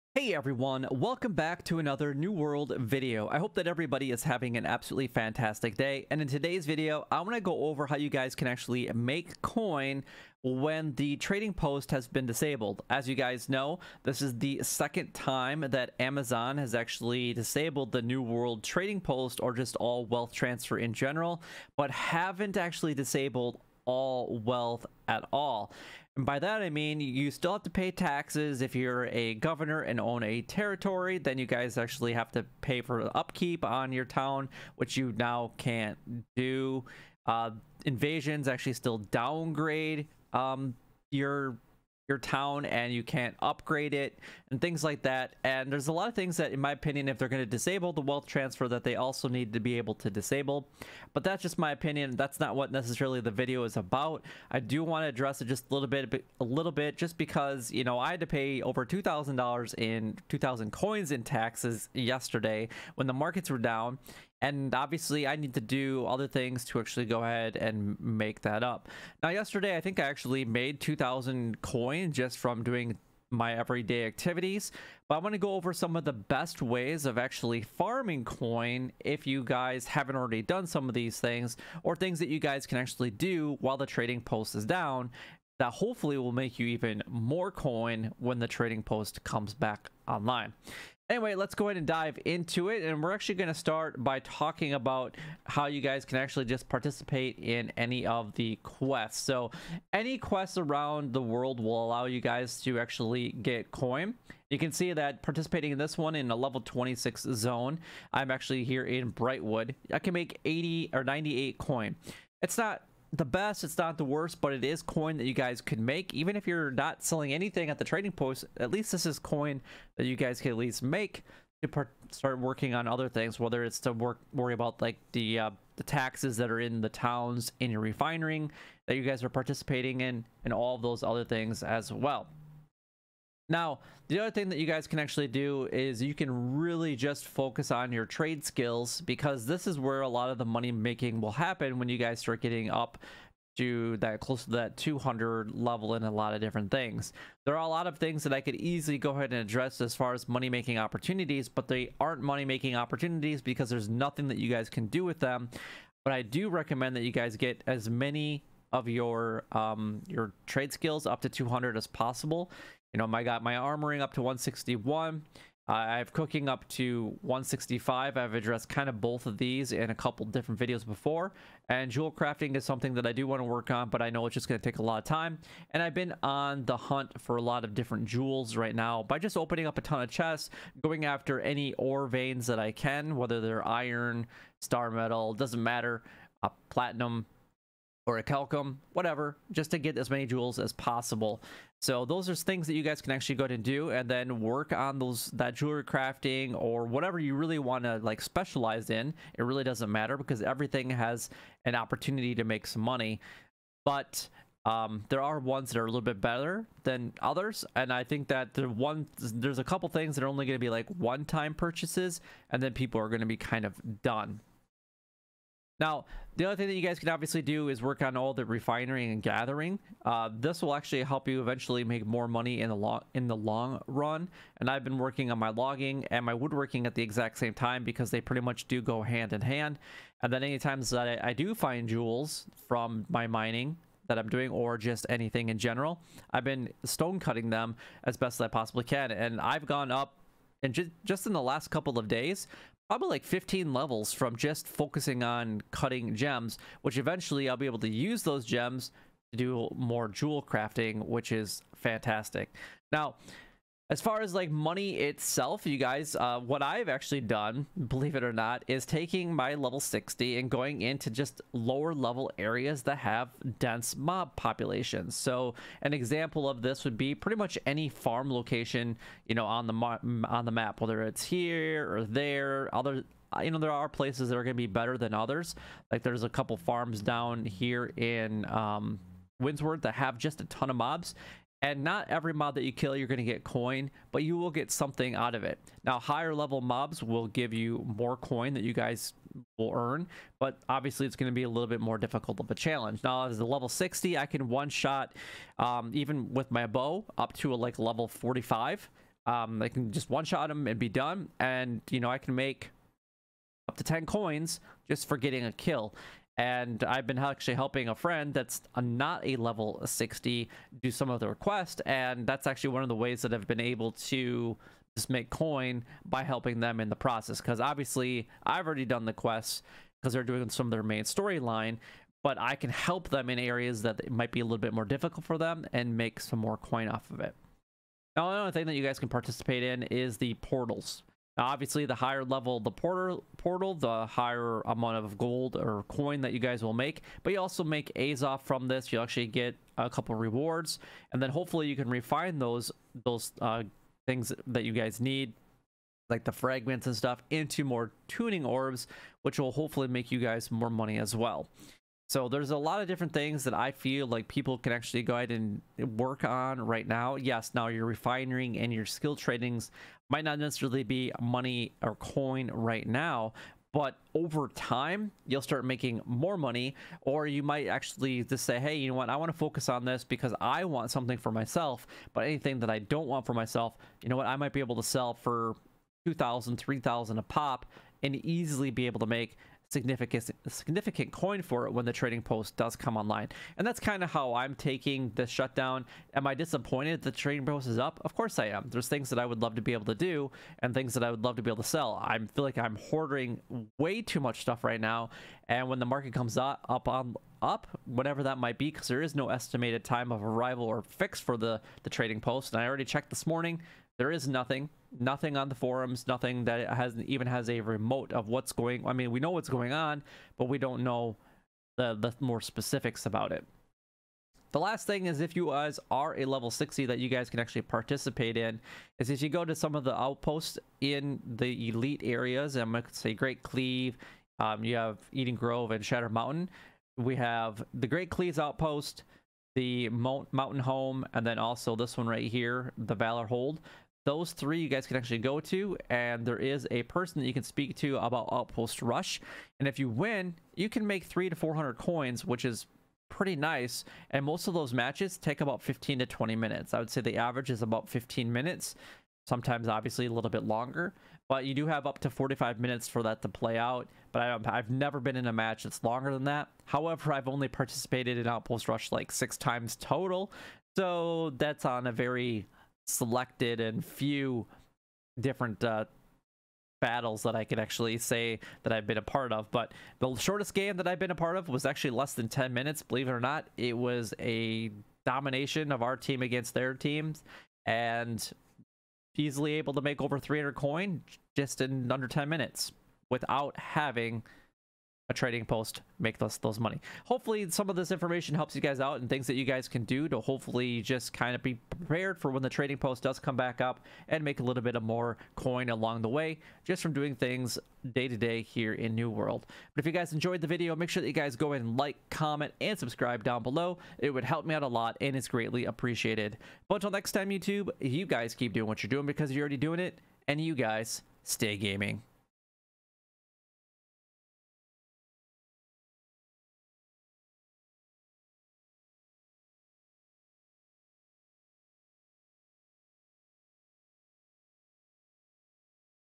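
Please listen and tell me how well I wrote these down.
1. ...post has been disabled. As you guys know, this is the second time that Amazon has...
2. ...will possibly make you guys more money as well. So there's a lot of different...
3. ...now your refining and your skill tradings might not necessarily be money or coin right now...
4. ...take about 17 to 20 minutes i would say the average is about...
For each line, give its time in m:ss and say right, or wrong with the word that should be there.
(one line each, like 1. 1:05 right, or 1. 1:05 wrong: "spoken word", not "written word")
1. 0:11 right
2. 5:49 wrong: "hopefully", not "possibly"
3. 5:57 right
4. 7:25 wrong: "15", not "17".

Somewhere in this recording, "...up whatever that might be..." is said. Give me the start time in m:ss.
6:37.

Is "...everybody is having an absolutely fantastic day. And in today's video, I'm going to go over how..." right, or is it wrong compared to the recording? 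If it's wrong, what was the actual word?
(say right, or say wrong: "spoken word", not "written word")
right.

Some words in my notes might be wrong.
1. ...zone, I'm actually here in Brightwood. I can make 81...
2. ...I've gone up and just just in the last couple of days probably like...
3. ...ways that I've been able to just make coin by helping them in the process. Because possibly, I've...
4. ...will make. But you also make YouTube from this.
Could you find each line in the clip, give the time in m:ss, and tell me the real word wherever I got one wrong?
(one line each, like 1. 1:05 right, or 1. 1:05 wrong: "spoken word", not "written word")
1. 1:47 wrong: "80", not "81"
2. 3:59 right
3. 5:12 wrong: "obviously", not "possibly"
4. 5:36 wrong: "Azoth", not "YouTube".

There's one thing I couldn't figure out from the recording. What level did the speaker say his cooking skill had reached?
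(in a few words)
165.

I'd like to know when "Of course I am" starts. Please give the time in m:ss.
6:28.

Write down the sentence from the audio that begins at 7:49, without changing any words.
But the shortest game that I've been a part of was actually less than 10 minutes, believe it or not.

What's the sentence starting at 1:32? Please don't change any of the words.
And we're actually going to start by talking about how you guys can actually just participate in any of the quests.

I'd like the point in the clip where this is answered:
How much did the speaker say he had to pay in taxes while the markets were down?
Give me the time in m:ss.
1:00.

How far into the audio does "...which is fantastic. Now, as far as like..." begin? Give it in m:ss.
4:11.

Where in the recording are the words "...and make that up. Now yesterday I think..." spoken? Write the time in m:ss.
1:07.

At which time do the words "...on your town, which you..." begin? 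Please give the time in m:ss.
0:33.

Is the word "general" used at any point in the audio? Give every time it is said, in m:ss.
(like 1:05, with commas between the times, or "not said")
0:20, 3:55.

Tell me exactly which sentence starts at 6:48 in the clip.
I mean, we know what's going on, but we don't know the the more specifics about it.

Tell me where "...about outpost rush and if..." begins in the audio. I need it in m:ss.
7:17.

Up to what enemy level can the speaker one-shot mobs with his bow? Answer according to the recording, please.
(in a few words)
45.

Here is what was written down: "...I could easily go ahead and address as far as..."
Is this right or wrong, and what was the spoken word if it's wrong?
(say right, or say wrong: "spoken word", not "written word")
right.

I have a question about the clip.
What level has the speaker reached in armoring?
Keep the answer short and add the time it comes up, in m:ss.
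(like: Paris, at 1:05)
161, at 2:44.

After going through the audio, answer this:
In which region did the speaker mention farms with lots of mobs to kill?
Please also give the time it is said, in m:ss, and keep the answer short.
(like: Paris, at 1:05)
Windsward, at 4:39.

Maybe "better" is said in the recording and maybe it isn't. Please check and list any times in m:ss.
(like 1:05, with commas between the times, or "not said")
3:26, 4:34.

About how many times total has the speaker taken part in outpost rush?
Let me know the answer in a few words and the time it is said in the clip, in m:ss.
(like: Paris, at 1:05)
6, at 7:39.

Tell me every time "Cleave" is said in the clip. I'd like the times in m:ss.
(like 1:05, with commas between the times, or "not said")
7:03, 7:08.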